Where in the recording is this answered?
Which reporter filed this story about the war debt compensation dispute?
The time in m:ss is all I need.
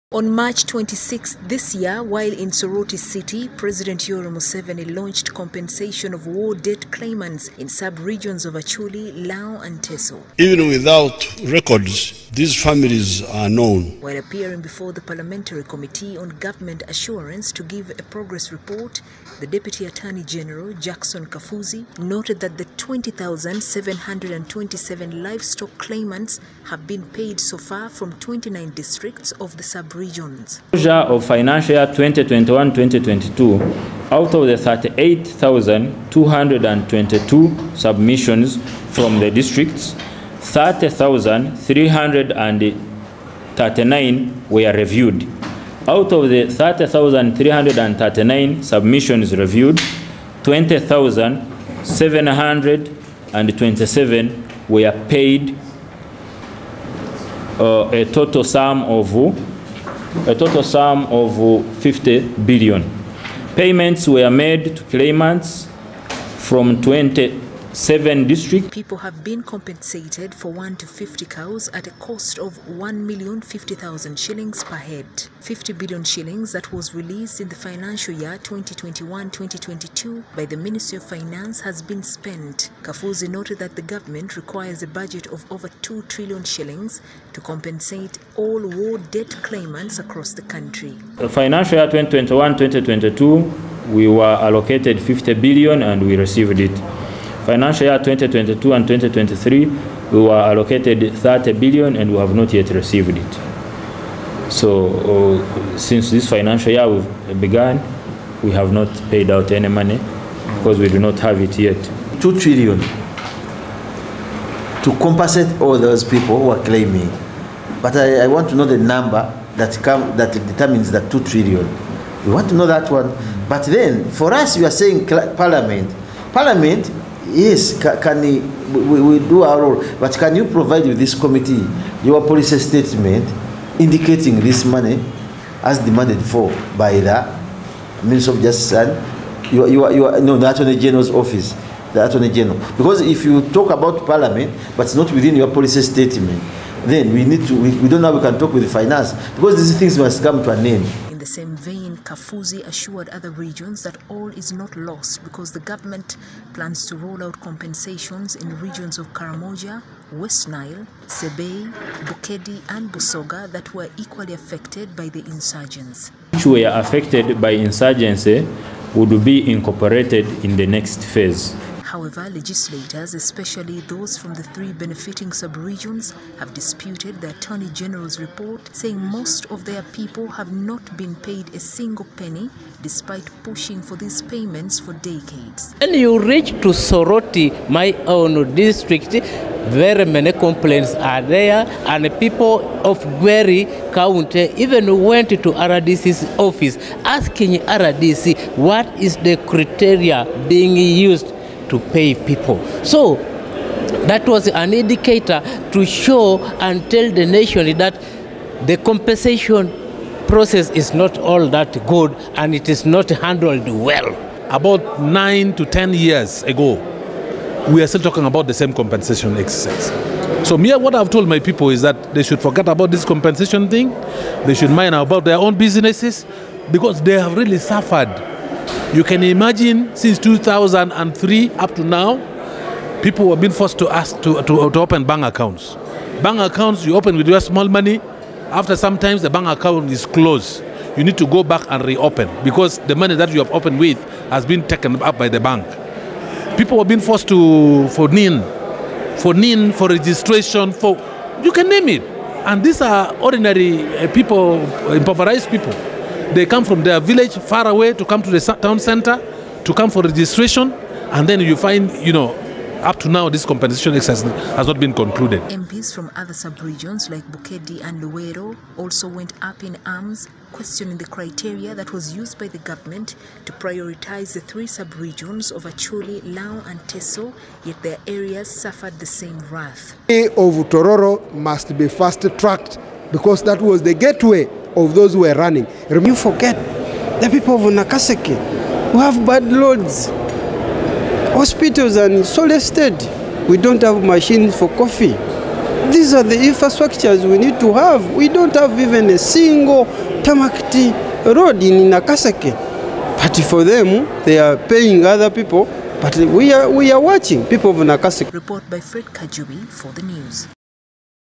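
5:08.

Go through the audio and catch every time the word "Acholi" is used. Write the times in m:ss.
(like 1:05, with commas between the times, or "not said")
0:08, 4:35.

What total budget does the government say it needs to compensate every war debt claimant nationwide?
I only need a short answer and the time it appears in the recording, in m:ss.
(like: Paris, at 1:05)
over 2 trillion shillings, at 1:25.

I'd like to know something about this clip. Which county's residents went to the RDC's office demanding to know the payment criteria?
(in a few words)
Gweri County.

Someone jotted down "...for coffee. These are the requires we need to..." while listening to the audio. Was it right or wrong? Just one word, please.
wrong.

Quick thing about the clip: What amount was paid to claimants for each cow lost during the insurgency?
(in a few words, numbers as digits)
1,050,000 shillings.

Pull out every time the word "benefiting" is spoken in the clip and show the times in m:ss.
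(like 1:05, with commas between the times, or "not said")
2:54.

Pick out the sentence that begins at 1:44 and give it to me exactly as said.
So uh, since this financial year we've we have not paid out any money because we do not have it yet.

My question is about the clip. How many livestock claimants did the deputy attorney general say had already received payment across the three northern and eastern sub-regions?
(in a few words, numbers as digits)
20,727.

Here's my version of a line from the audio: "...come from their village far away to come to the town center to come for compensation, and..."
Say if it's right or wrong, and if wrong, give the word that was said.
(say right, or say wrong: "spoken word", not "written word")
wrong: "registration", not "compensation".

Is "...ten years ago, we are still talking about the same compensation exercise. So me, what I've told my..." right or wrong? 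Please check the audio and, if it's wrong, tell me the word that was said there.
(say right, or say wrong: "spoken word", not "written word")
right.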